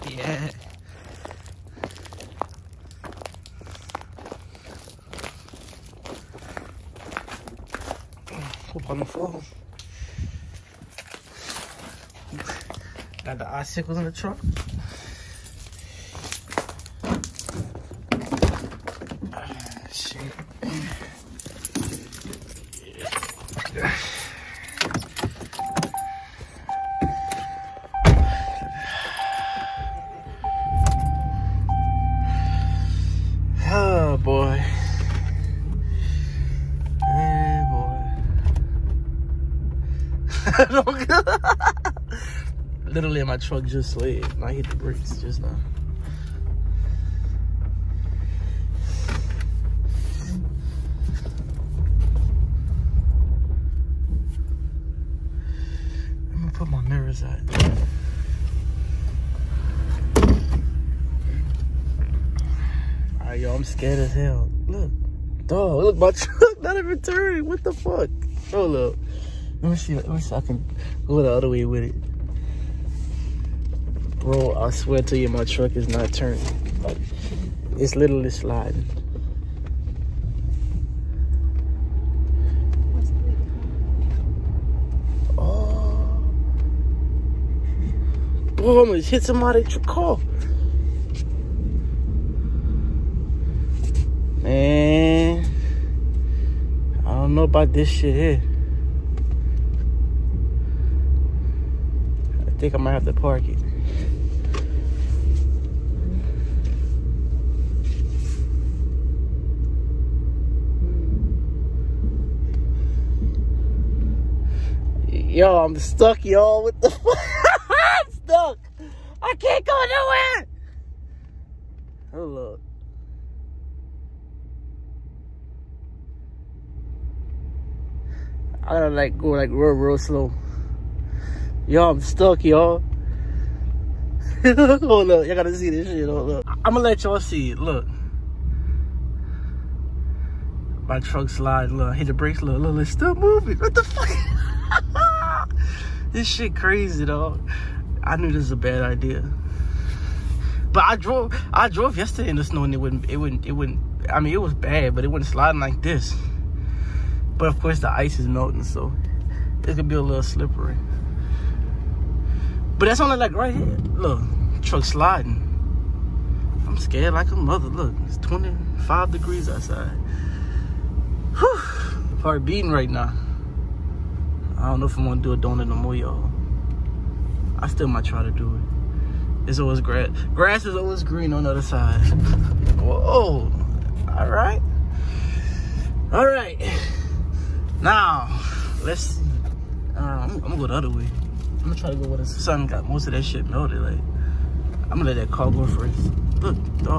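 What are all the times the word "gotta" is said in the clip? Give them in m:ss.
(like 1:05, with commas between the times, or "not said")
2:08, 2:15.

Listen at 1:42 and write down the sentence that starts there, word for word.
think I might have to park it.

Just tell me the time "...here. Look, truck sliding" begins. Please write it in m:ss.
2:43.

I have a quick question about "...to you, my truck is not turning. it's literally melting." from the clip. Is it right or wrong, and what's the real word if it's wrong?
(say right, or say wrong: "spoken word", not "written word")
wrong: "sliding", not "melting".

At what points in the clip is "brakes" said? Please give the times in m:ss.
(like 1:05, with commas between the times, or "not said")
0:44, 2:22.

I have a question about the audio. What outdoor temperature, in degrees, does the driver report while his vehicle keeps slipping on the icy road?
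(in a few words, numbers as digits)
25 degrees.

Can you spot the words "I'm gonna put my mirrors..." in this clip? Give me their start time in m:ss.
0:56.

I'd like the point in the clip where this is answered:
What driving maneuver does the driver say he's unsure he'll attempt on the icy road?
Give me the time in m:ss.
2:55.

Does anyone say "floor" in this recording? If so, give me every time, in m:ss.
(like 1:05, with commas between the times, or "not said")
0:09.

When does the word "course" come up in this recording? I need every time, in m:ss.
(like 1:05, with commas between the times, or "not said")
2:37.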